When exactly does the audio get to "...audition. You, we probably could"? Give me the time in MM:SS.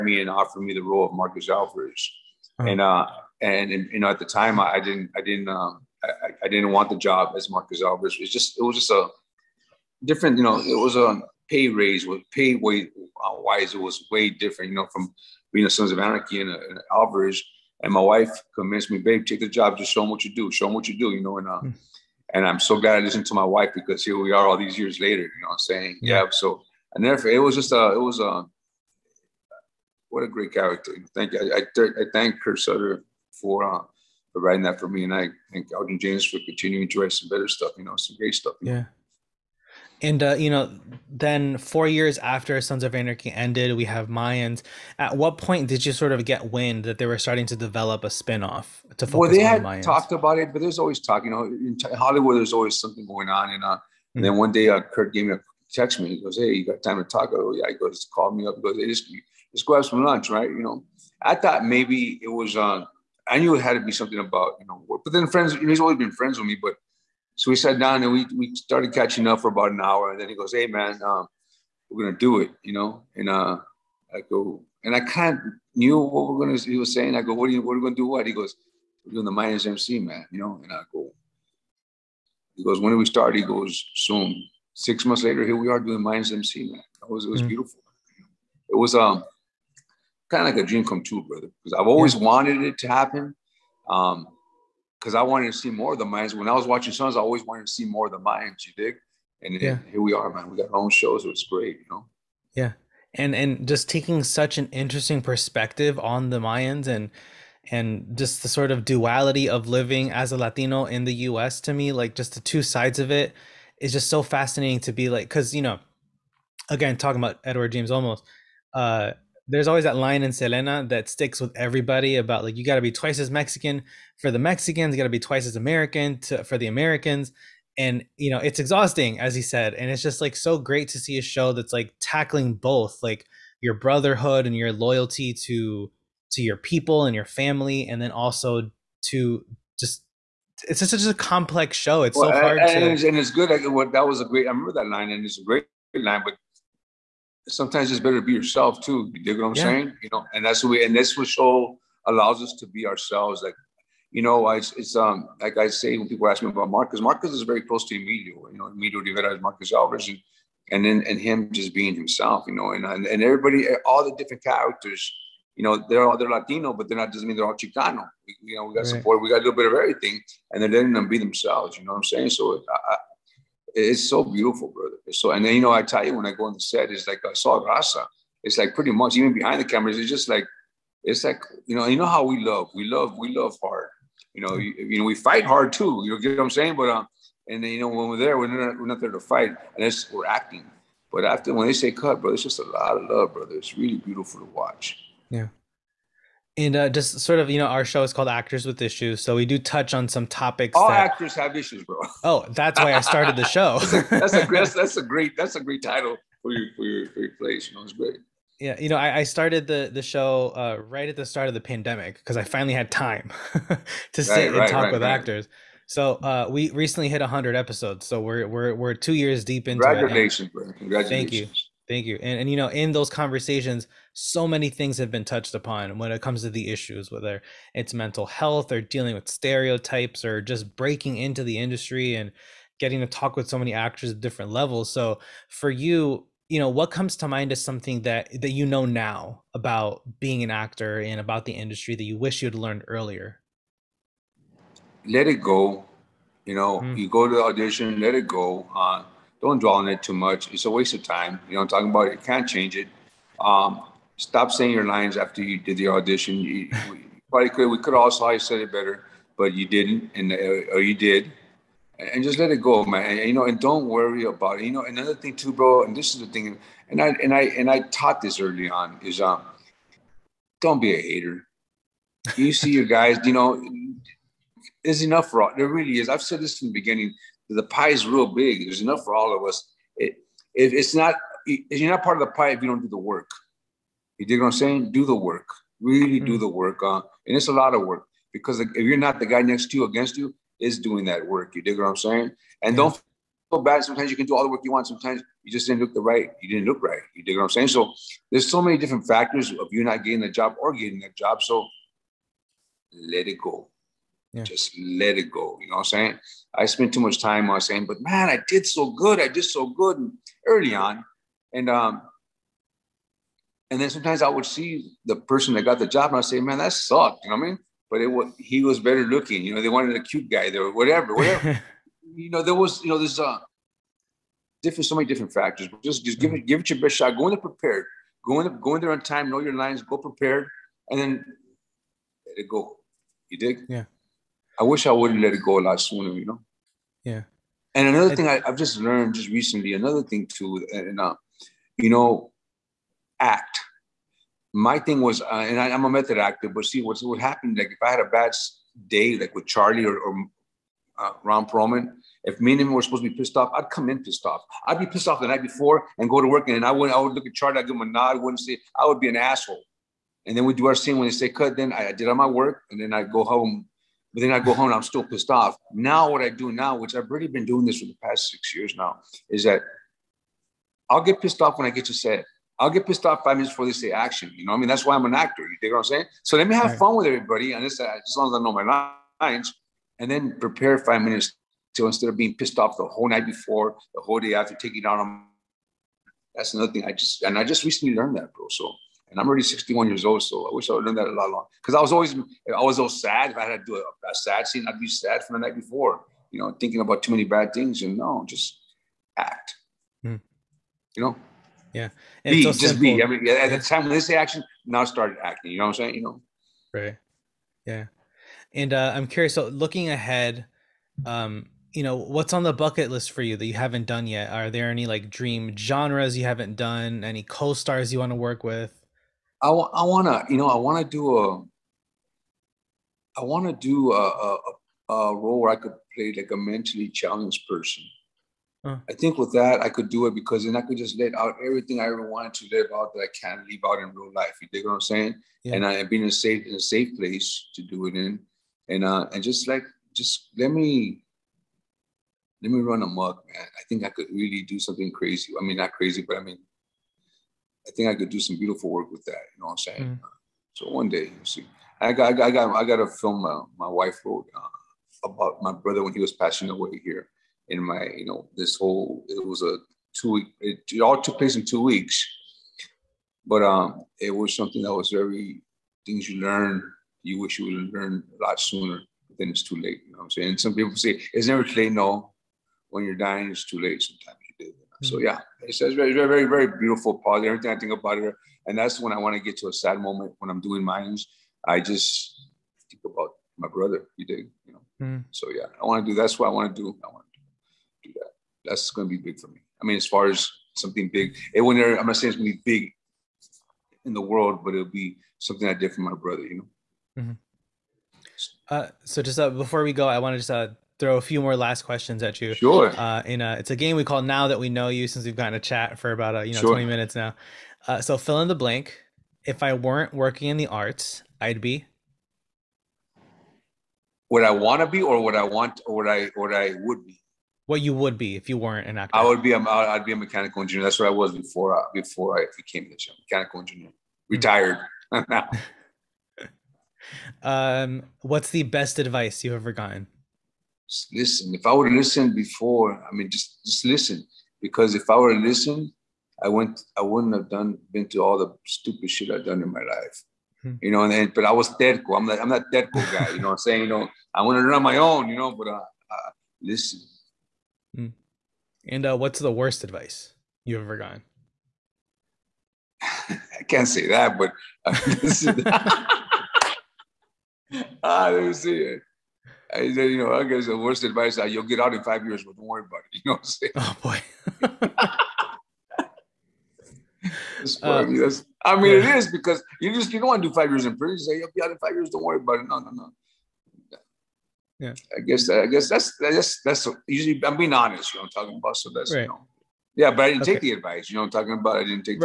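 04:15.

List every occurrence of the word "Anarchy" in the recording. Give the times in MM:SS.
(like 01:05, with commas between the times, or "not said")
00:15, 00:42.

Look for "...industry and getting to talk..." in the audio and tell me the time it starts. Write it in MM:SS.
03:51.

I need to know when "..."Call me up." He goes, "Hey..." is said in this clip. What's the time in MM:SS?
00:58.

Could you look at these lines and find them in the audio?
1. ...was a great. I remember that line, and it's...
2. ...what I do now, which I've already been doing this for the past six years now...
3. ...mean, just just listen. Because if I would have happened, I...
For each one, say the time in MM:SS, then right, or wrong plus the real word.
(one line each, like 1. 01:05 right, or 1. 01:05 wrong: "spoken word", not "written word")
1. 02:24 right
2. 06:06 right
3. 08:52 wrong: "listened", not "happened".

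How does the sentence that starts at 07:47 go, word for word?
You wish you would learn a lot sooner.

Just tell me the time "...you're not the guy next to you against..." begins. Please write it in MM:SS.
04:48.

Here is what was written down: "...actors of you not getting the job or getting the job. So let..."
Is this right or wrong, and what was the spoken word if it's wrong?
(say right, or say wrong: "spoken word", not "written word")
wrong: "factors", not "actors".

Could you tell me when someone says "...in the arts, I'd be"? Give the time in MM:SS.
08:30.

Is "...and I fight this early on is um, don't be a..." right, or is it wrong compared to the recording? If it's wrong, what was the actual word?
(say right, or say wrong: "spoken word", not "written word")
wrong: "taught", not "fight".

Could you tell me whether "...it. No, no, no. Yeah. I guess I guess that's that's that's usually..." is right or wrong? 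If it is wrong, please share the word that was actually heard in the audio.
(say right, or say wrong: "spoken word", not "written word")
right.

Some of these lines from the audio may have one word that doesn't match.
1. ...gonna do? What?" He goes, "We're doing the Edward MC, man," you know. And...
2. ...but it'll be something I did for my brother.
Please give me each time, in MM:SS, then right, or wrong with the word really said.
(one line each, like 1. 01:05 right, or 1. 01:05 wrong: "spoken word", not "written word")
1. 01:17 wrong: "Mayans", not "Edward"
2. 08:14 right.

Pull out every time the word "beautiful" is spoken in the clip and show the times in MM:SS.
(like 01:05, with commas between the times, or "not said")
01:27, 02:54, 03:13, 07:28, 07:56.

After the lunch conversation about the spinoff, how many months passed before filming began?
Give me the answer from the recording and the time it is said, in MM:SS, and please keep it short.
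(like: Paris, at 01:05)
6 months, at 01:24.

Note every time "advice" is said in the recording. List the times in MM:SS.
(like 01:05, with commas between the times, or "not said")
08:48, 09:09, 09:20, 09:40.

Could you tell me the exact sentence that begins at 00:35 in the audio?
And I thank Elgin James for continuing to write some better stuff, you know, some great stuff.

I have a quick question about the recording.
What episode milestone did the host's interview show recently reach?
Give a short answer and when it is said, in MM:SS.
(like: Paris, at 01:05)
100 episodes, at 03:37.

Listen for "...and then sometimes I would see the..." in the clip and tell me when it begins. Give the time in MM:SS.
05:13.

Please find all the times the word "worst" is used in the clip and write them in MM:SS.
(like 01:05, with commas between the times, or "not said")
09:09, 09:20.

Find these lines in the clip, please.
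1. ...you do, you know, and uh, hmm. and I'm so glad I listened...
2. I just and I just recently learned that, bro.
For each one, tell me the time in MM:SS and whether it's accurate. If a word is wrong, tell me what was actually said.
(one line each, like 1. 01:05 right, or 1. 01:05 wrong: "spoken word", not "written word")
1. 00:20 right
2. 06:26 right.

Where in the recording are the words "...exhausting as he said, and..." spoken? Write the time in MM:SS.
02:08.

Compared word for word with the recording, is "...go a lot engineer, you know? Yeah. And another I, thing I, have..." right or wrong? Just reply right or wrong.
wrong.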